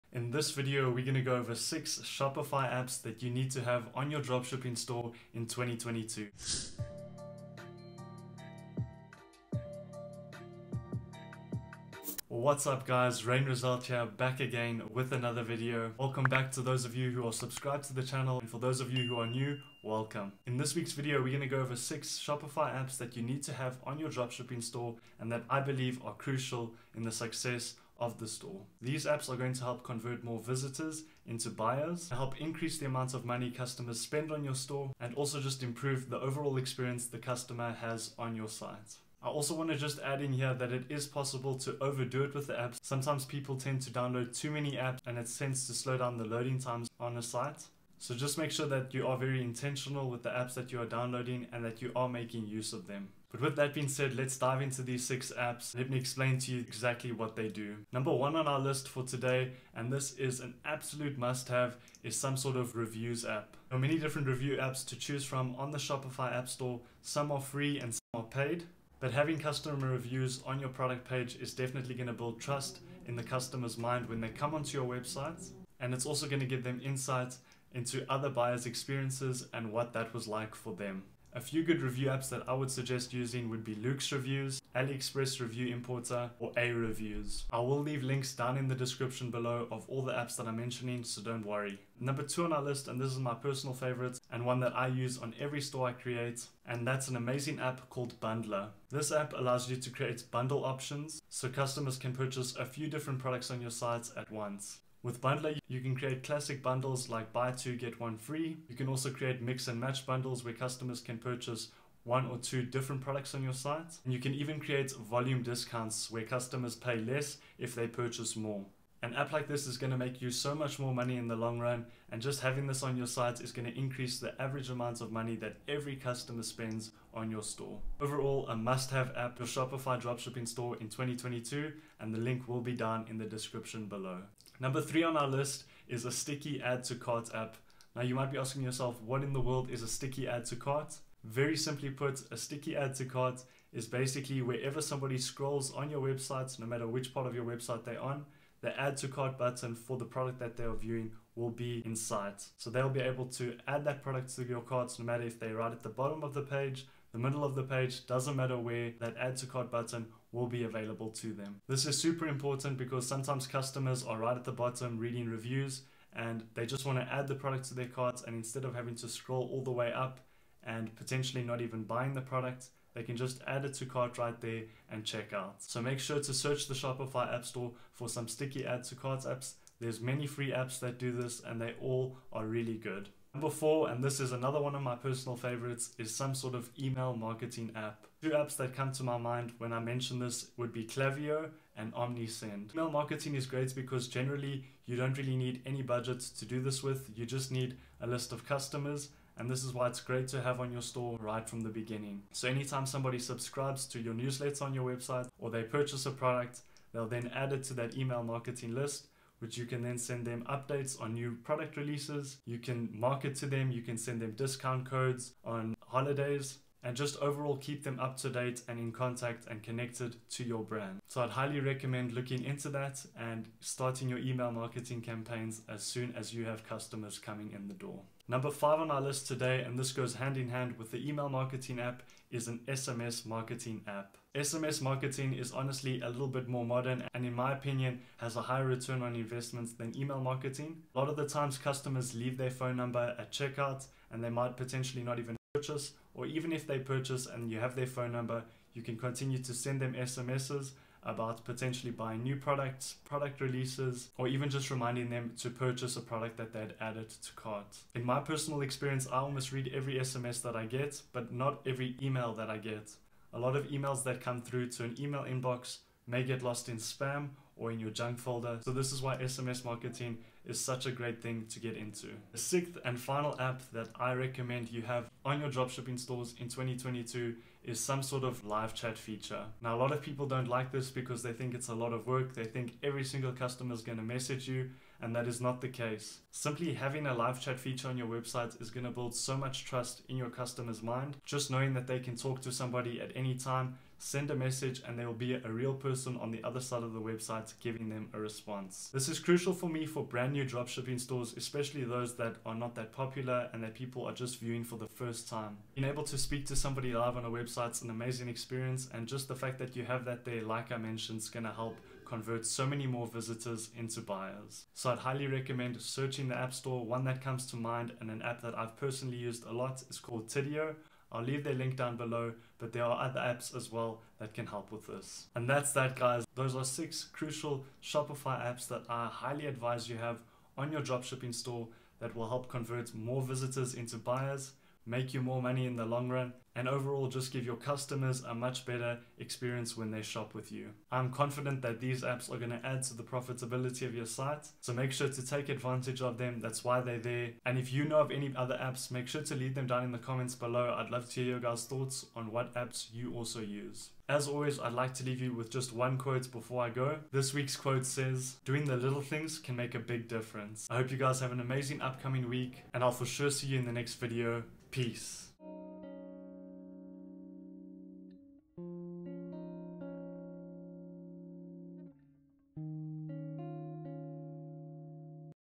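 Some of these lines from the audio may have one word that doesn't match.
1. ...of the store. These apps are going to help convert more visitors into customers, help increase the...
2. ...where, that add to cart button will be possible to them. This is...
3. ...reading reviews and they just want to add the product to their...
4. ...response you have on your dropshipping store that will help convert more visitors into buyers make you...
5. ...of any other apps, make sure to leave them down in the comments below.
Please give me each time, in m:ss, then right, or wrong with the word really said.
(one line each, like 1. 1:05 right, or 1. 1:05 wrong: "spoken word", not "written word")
1. 0:28 wrong: "buyers", not "customers"
2. 2:38 wrong: "available", not "possible"
3. 2:44 right
4. 5:29 wrong: "advise", not "response"
5. 5:48 right.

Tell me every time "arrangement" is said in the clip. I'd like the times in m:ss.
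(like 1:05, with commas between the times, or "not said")
not said.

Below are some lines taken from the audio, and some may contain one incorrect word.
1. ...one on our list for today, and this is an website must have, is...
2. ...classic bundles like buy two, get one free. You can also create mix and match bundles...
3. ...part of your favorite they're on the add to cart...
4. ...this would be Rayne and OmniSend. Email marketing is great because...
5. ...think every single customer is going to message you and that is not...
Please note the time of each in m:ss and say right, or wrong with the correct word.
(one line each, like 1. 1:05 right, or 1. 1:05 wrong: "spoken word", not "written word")
1. 0:58 wrong: "absolute", not "website"
2. 1:46 right
3. 2:27 wrong: "website", not "favorite"
4. 3:10 wrong: "Klaviyo", not "Rayne"
5. 4:42 right.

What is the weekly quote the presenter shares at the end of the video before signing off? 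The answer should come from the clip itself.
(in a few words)
Doing the little things can make a big difference.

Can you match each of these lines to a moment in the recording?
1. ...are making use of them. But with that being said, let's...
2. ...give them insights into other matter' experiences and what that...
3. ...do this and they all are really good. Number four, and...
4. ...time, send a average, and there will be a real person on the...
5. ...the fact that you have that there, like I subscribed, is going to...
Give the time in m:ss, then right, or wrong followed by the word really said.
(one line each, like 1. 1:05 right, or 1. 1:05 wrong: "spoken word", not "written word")
1. 0:51 right
2. 1:16 wrong: "buyers", not "matter"
3. 3:00 right
4. 4:53 wrong: "message", not "average"
5. 5:09 wrong: "mentioned", not "subscribed".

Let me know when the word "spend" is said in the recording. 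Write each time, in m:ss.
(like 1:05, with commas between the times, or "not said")
0:34, 2:06.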